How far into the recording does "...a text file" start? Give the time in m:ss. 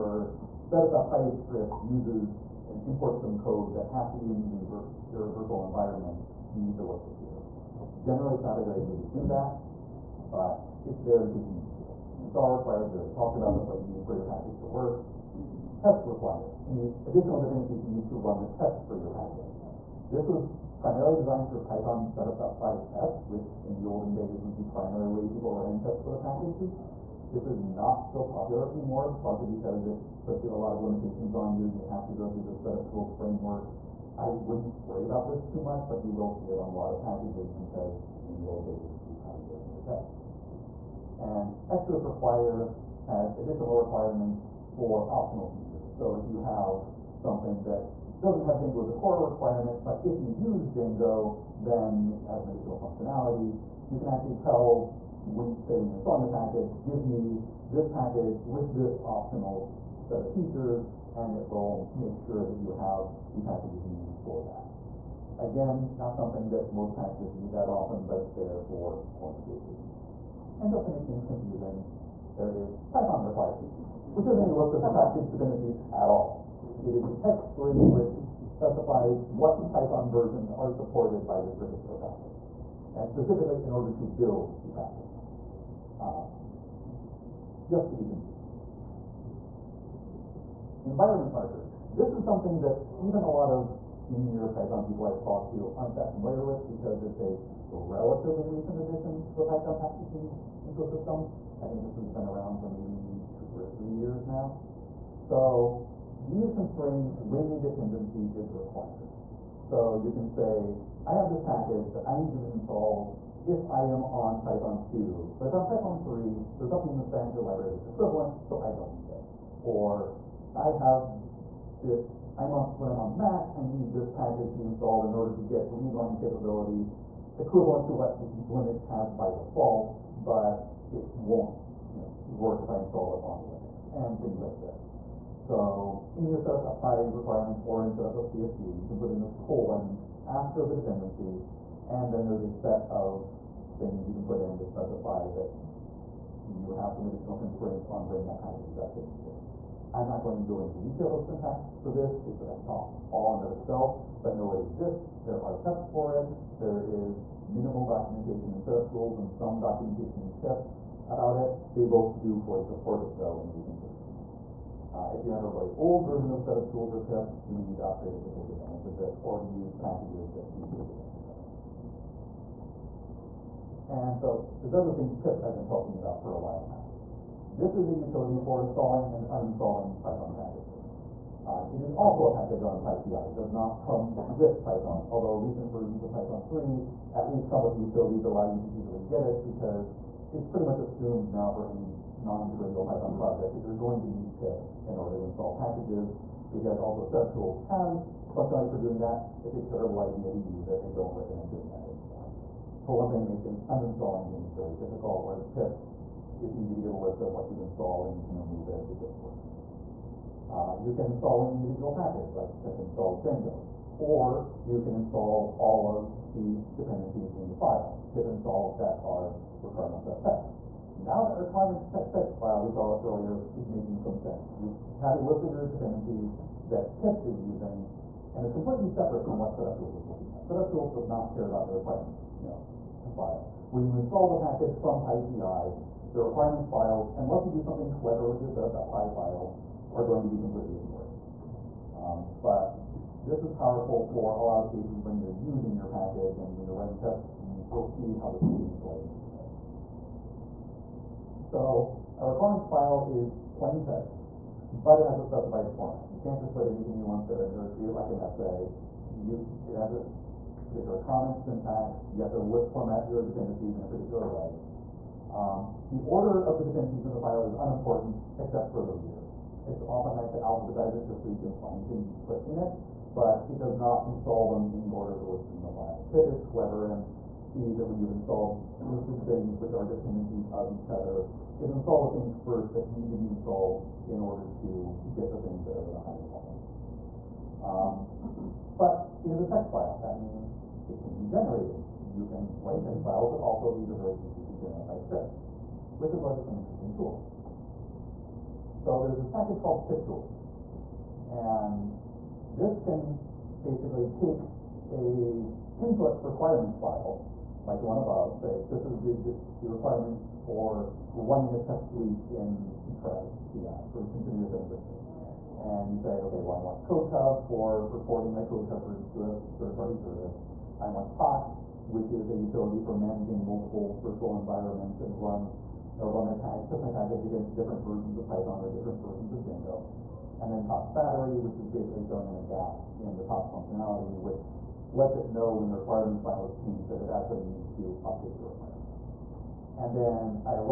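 4:49.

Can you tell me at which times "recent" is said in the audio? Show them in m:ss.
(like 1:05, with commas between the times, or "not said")
1:38, 2:43, 3:05.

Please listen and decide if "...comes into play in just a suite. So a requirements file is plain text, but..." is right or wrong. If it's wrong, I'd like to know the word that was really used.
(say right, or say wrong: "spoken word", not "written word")
wrong: "minute", not "suite".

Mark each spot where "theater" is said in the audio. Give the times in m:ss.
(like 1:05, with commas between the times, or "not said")
not said.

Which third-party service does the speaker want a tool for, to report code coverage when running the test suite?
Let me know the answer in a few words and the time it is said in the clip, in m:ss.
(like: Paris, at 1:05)
CodeCov, at 5:16.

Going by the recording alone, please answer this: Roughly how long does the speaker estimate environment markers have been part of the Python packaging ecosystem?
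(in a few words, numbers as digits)
two or three years.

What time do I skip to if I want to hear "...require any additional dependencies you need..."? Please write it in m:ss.
0:16.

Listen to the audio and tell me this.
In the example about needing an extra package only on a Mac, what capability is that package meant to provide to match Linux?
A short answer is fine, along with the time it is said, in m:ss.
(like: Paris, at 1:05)
readline, at 2:05.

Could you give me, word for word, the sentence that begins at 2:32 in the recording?
It's a talk all in of itself, but know it exists.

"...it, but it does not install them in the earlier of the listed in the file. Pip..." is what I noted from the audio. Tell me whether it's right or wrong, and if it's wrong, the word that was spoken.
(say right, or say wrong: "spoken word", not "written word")
wrong: "order", not "earlier".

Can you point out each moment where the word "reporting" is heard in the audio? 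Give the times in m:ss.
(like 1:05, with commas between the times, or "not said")
5:17.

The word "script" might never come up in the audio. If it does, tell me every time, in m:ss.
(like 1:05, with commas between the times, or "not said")
0:01, 4:54.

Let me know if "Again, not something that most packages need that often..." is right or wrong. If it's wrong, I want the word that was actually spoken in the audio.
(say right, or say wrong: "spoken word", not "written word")
right.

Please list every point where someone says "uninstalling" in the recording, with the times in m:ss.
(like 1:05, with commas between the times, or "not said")
2:59, 3:23.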